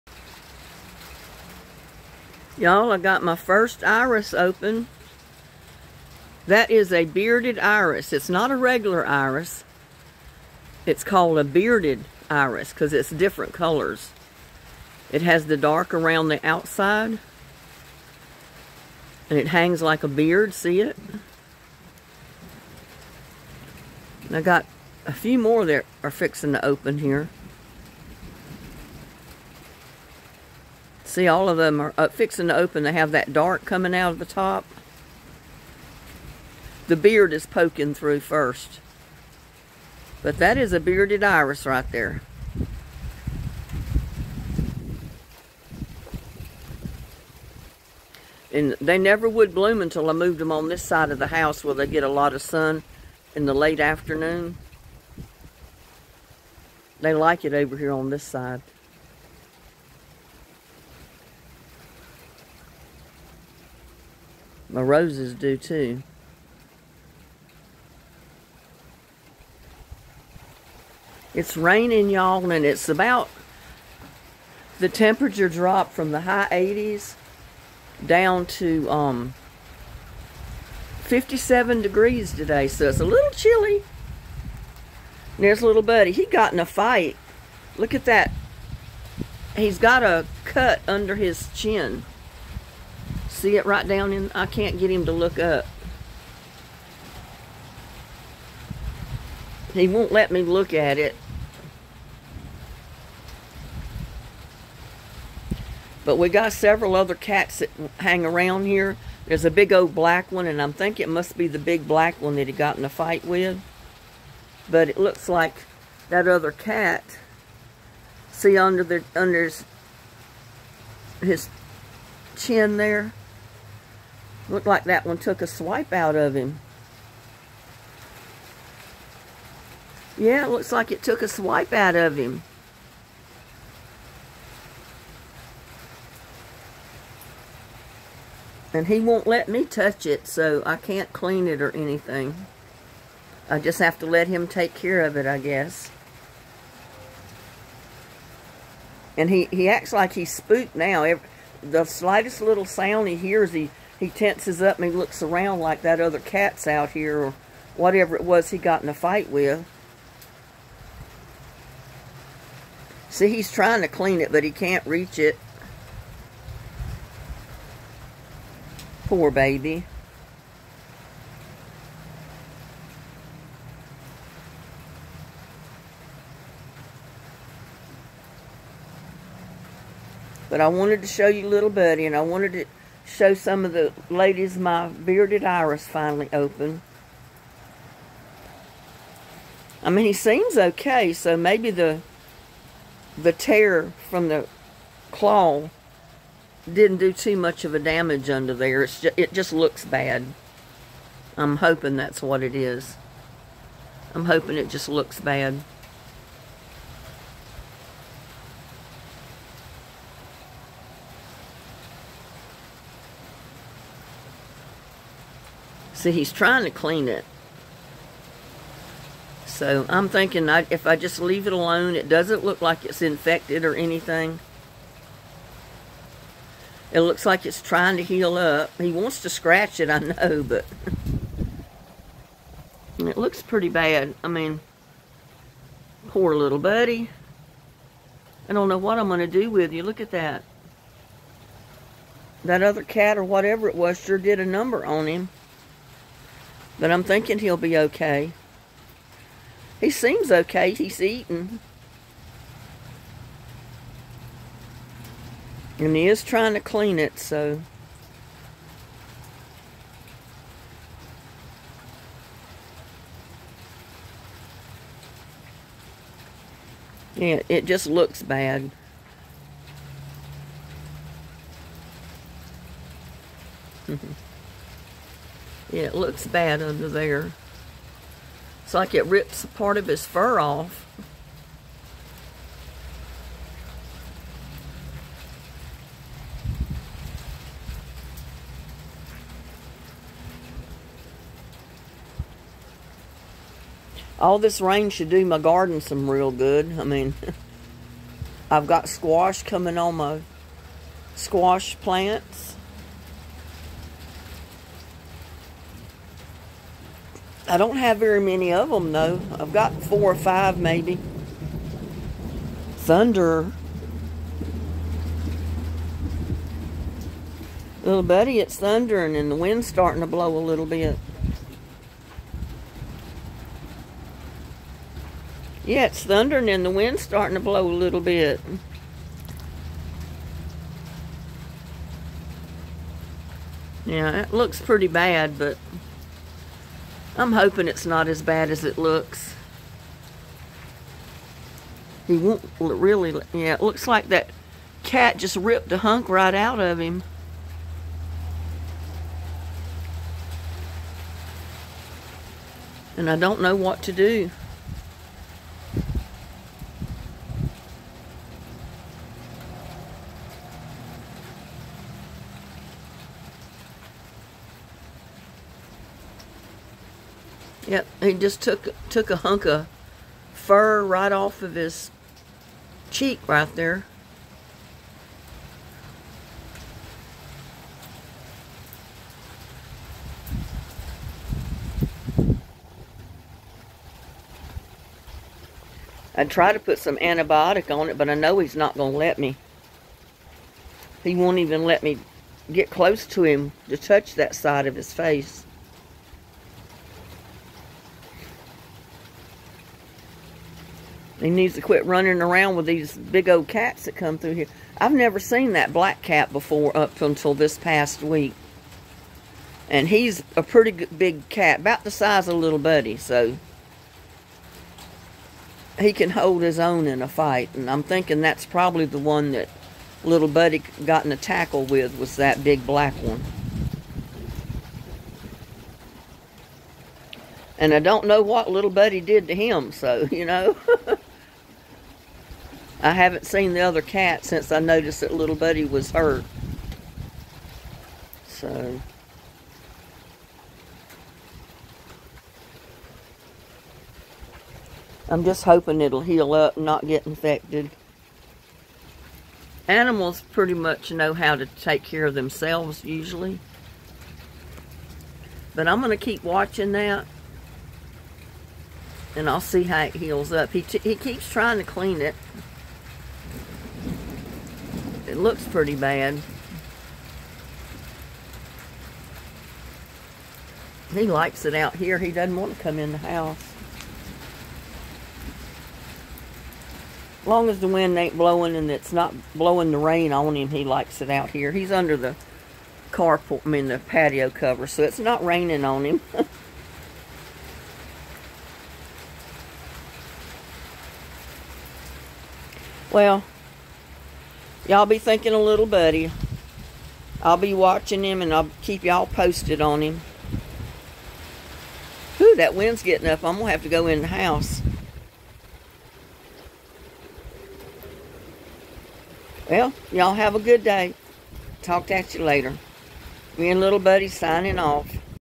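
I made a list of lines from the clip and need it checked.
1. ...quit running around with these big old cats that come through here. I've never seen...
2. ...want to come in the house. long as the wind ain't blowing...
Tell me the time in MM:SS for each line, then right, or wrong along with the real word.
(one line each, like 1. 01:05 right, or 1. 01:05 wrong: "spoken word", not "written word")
1. 06:41 right
2. 07:52 right.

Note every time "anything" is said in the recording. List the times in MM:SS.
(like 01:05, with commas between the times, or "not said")
02:21, 03:43.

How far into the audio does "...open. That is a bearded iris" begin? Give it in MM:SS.
00:04.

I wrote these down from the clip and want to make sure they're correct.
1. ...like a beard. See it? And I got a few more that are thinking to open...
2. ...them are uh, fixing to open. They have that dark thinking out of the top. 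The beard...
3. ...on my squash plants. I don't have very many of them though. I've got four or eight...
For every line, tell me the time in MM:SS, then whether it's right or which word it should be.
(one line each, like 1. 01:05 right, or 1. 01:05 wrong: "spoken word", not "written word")
1. 00:19 wrong: "fixing", not "thinking"
2. 00:31 wrong: "coming", not "thinking"
3. 04:59 wrong: "five", not "eight".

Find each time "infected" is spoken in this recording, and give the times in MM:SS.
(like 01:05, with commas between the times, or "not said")
03:43, 07:27.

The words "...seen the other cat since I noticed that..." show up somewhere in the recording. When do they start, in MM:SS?
07:13.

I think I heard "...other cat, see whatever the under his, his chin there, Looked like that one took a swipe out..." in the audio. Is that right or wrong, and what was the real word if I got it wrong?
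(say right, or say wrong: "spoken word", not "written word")
wrong: "under", not "whatever".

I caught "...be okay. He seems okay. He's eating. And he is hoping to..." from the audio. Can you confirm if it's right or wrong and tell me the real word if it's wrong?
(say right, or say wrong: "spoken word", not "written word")
wrong: "trying", not "hoping".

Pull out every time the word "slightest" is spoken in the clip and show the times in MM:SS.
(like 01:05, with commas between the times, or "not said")
02:31.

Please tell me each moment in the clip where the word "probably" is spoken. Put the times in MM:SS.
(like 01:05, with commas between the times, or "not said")
06:58.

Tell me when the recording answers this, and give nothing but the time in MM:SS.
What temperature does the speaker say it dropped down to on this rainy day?
01:21.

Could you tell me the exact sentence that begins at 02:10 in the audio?
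Yeah, looks like it took a swipe out of him.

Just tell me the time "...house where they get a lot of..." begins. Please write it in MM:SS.
00:51.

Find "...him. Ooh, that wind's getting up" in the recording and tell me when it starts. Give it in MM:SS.
08:19.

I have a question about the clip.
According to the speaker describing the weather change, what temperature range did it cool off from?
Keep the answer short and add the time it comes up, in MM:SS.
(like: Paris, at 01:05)
High 80s, at 01:16.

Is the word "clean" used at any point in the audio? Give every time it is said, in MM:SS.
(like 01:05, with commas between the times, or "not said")
02:21, 02:43, 03:36, 04:16, 07:41.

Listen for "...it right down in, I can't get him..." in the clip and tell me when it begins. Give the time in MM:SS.
01:33.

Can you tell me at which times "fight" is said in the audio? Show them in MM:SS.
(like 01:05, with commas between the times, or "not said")
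01:26, 01:52, 02:38, 06:57.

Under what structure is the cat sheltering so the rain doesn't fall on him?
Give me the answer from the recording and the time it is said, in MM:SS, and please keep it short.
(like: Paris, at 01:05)
Patio cover, at 08:03.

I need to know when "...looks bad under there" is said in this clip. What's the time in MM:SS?
04:35.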